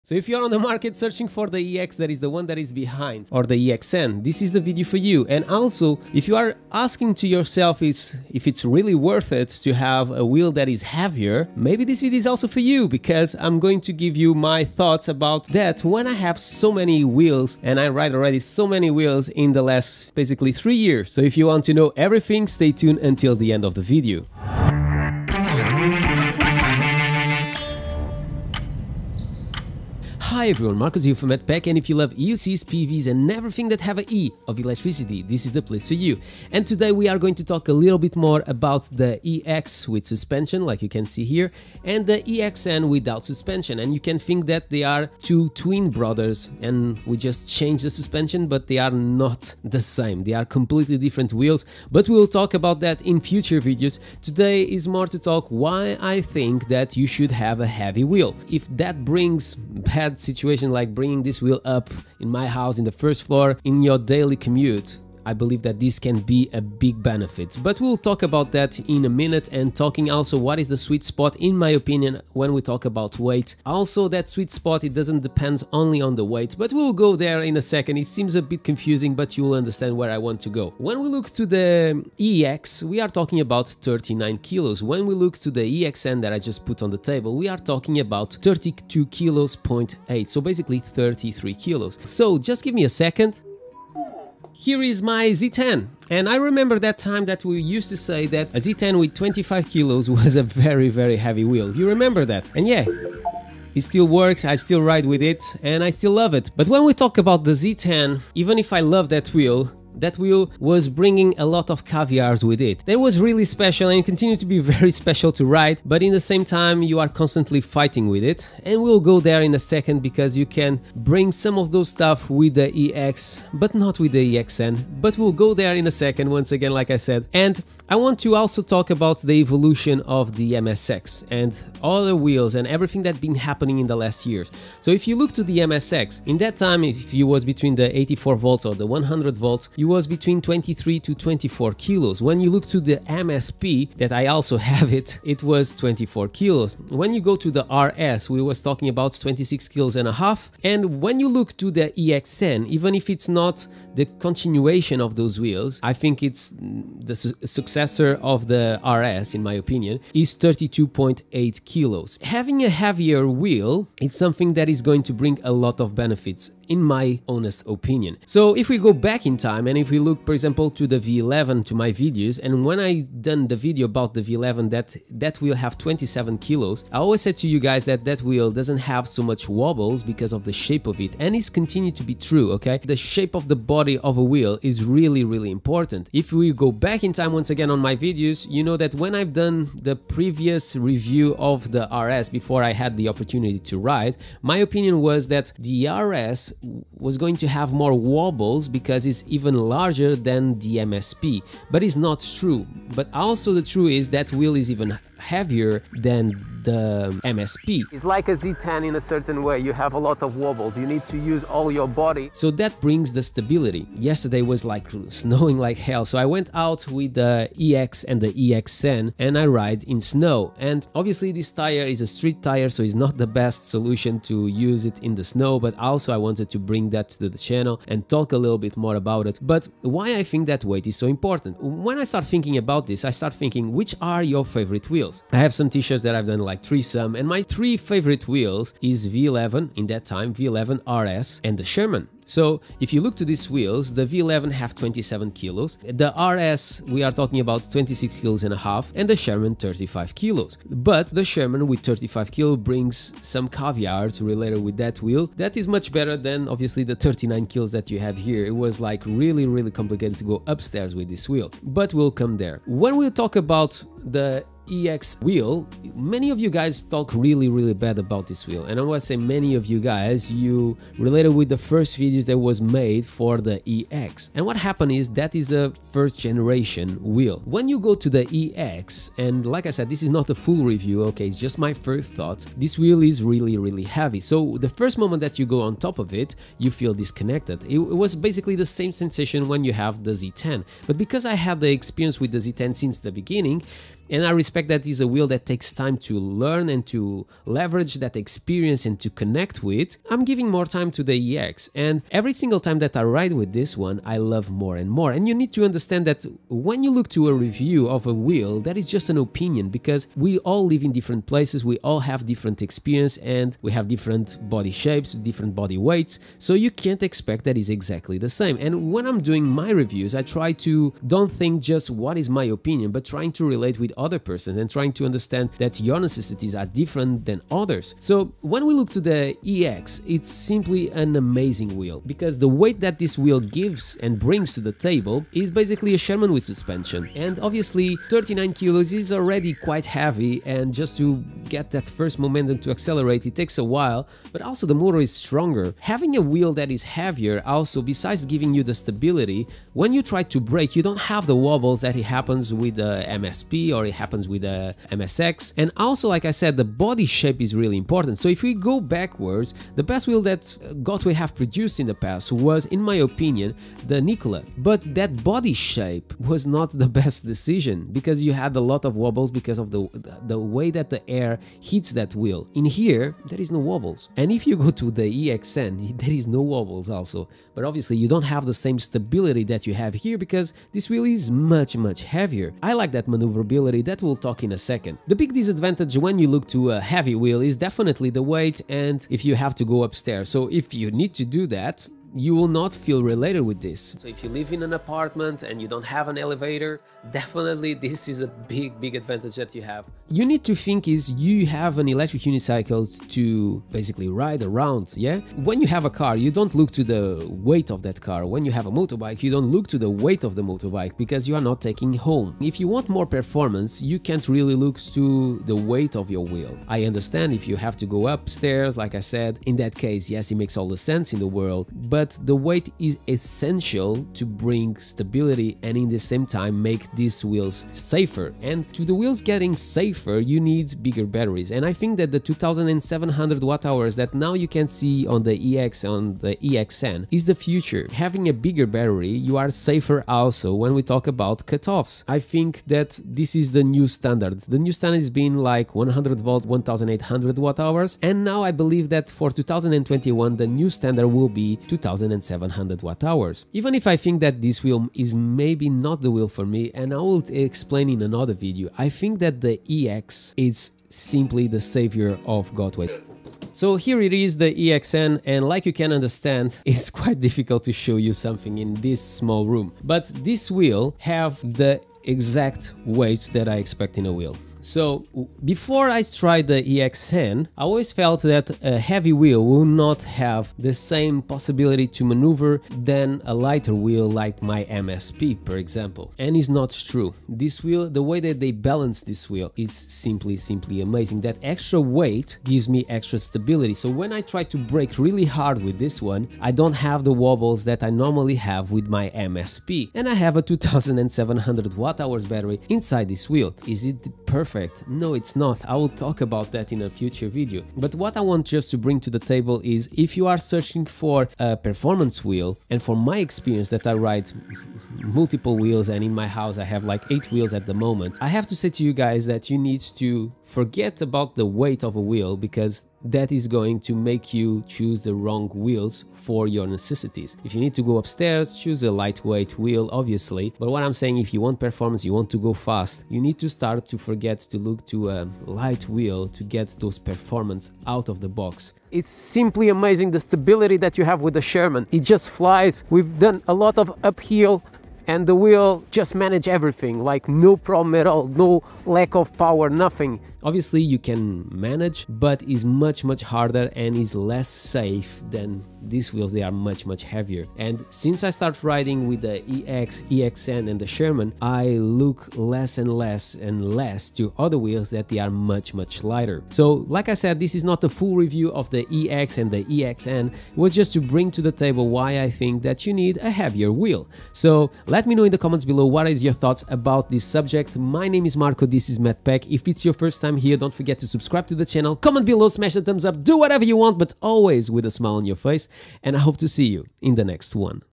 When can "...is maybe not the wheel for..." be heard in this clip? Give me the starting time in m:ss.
7:34.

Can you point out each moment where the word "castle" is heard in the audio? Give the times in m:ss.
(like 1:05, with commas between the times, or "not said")
not said.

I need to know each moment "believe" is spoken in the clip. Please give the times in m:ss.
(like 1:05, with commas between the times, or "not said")
1:05, 7:28.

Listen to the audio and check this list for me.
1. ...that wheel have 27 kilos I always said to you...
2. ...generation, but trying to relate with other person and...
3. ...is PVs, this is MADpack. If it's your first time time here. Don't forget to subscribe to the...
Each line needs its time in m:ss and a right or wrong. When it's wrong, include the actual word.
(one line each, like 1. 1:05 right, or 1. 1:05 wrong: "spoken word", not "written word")
1. 2:55 right
2. 5:22 wrong: "opinion", not "generation"
3. 9:38 wrong: "Marco", not "PVs".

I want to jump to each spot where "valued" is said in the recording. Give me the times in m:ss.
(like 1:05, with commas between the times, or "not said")
not said.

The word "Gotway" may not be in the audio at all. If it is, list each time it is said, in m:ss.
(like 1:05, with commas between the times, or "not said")
6:00, 7:42.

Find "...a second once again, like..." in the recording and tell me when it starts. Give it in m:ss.
2:05.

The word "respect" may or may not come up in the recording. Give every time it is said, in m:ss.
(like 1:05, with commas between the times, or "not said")
4:54.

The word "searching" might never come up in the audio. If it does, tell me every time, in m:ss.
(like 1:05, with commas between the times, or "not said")
0:00, 8:30.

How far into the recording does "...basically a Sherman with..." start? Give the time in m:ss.
5:35.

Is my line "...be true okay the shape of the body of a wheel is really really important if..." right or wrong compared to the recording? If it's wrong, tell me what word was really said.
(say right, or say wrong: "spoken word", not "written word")
right.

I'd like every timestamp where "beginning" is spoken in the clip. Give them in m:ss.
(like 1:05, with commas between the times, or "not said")
4:53.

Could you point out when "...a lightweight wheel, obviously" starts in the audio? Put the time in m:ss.
8:48.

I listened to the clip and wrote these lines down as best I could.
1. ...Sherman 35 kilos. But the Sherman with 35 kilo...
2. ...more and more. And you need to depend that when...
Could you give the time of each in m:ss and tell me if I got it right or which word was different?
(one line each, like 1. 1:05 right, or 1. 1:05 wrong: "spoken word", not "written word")
1. 4:09 right
2. 5:04 wrong: "understand", not "depend".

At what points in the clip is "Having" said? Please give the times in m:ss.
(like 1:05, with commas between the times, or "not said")
2:42, 5:45, 7:18.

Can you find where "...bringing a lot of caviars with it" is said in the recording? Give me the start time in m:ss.
1:50.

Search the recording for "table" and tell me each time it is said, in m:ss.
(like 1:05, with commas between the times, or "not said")
1:26, 5:34, 8:29, 9:31.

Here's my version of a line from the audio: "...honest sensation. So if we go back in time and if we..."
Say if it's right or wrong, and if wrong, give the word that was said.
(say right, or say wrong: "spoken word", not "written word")
wrong: "opinion", not "sensation".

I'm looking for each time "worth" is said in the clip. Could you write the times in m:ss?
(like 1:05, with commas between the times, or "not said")
0:08.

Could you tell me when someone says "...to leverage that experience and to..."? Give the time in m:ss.
4:56.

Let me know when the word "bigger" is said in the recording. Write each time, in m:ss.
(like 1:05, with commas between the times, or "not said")
7:10, 7:18.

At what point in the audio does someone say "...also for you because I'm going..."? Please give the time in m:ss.
0:12.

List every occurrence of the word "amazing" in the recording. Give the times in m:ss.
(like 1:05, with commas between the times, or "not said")
5:31, 8:10, 8:59.